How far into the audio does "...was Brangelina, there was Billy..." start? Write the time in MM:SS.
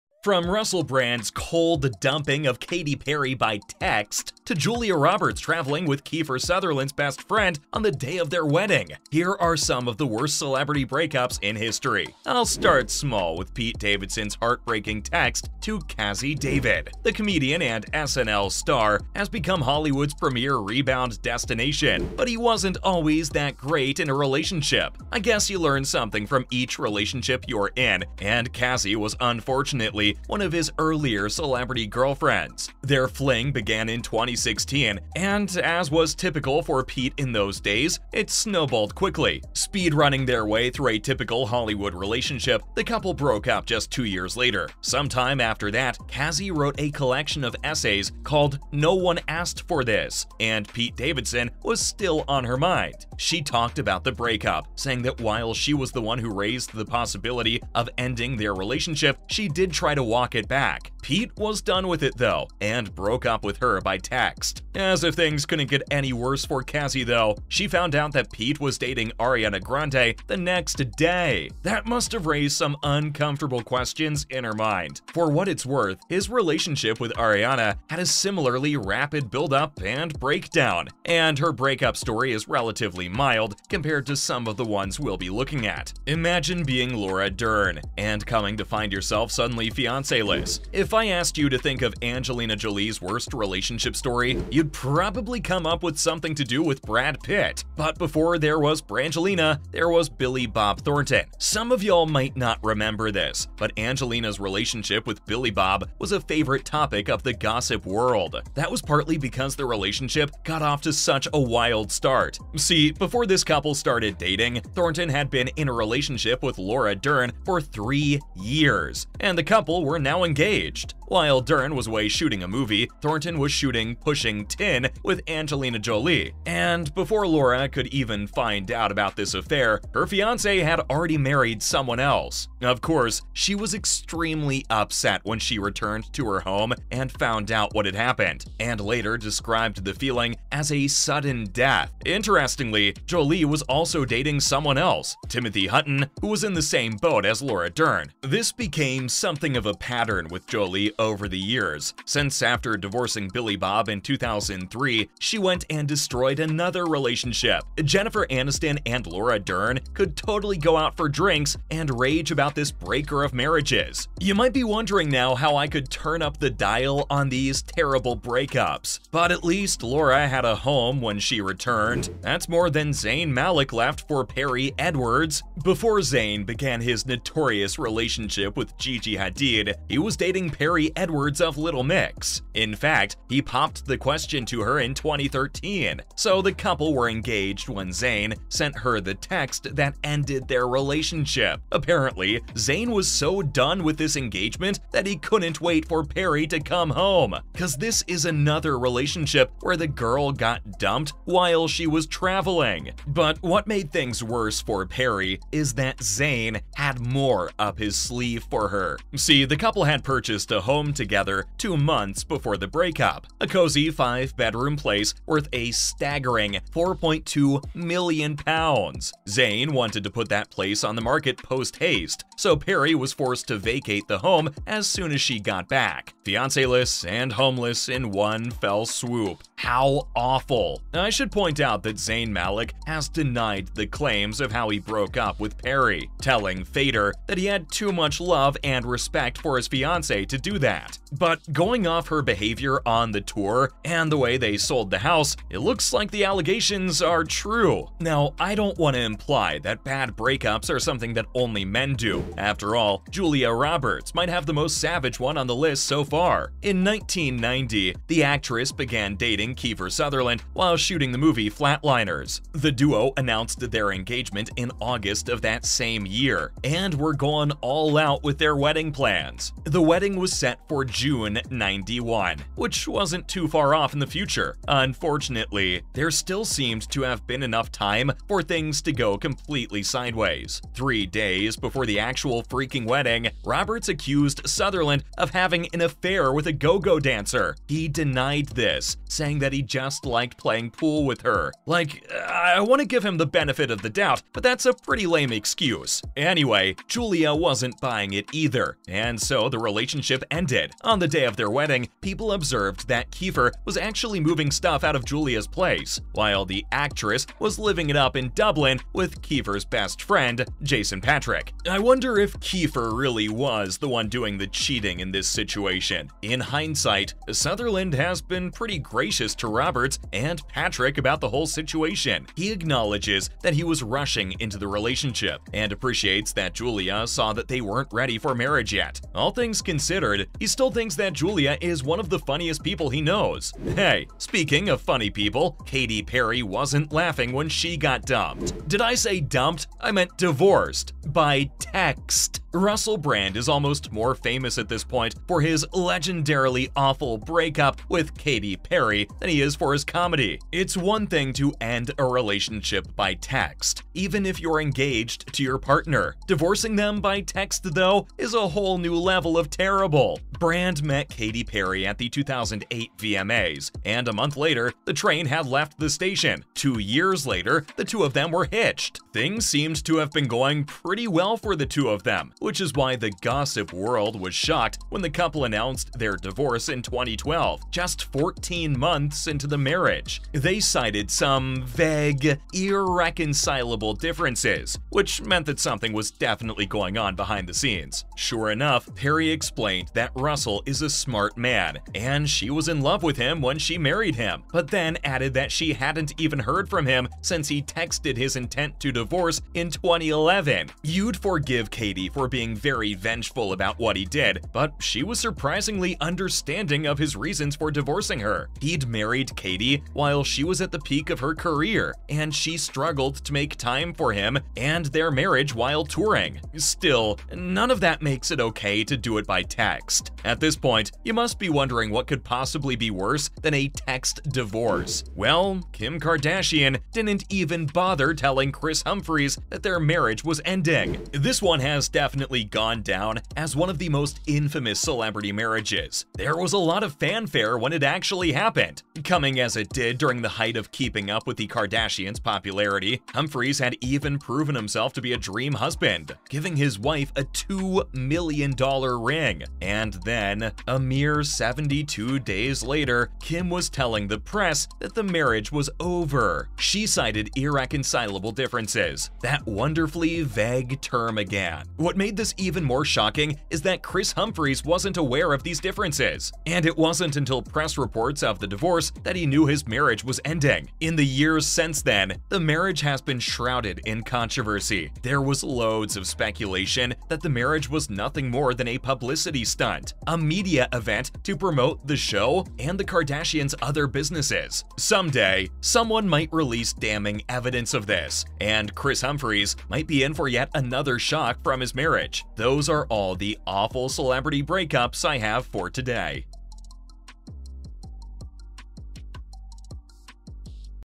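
01:38.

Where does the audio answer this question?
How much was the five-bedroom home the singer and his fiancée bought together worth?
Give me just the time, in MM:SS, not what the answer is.
03:36.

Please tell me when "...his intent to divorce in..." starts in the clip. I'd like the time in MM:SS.
06:38.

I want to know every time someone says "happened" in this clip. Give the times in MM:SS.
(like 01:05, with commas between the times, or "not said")
02:17, 07:18.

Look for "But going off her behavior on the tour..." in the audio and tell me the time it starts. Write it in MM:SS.
04:01.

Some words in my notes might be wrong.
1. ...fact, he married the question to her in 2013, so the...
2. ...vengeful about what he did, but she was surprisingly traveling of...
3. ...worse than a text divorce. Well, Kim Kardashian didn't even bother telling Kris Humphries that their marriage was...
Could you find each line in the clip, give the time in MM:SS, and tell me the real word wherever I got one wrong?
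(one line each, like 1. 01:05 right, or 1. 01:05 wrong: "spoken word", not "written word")
1. 03:02 wrong: "popped", not "married"
2. 06:42 wrong: "understanding", not "traveling"
3. 07:02 right.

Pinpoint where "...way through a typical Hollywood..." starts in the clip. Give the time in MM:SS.
00:40.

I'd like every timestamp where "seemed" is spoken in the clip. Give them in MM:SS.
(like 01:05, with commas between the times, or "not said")
04:36, 06:09.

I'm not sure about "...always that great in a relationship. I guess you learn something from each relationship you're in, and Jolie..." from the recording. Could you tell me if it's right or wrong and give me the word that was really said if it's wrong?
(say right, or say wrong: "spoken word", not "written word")
wrong: "Cazzie", not "Jolie".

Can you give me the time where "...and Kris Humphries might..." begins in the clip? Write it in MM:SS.
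08:08.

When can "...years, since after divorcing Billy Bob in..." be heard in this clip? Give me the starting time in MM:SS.
02:31.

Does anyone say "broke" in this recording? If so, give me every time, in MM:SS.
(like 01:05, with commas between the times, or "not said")
00:43, 01:02, 03:54.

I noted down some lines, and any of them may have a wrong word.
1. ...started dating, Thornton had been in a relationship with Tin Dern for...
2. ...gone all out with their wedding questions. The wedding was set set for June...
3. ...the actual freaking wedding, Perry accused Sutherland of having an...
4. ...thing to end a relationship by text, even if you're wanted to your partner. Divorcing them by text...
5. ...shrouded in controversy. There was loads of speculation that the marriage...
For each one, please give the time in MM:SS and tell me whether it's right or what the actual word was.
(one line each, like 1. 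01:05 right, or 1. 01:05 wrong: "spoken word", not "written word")
1. 01:53 wrong: "Laura", not "Tin"
2. 04:27 wrong: "plans", not "questions"
3. 04:41 wrong: "Roberts", not "Perry"
4. 05:51 wrong: "engaged", not "wanted"
5. 07:53 right.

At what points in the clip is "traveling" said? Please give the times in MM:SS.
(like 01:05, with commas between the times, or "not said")
00:05, 03:22.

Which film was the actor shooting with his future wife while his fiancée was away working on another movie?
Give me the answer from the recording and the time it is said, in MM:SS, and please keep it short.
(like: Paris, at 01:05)
Pushing Tin, at 02:03.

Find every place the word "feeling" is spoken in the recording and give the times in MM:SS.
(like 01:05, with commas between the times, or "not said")
02:19.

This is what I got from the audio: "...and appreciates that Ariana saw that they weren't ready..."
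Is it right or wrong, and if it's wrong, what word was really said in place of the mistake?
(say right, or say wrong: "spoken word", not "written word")
wrong: "Julia", not "Ariana".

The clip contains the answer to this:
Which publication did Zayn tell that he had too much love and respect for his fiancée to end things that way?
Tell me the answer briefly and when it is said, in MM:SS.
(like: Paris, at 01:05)
Fader, at 03:56.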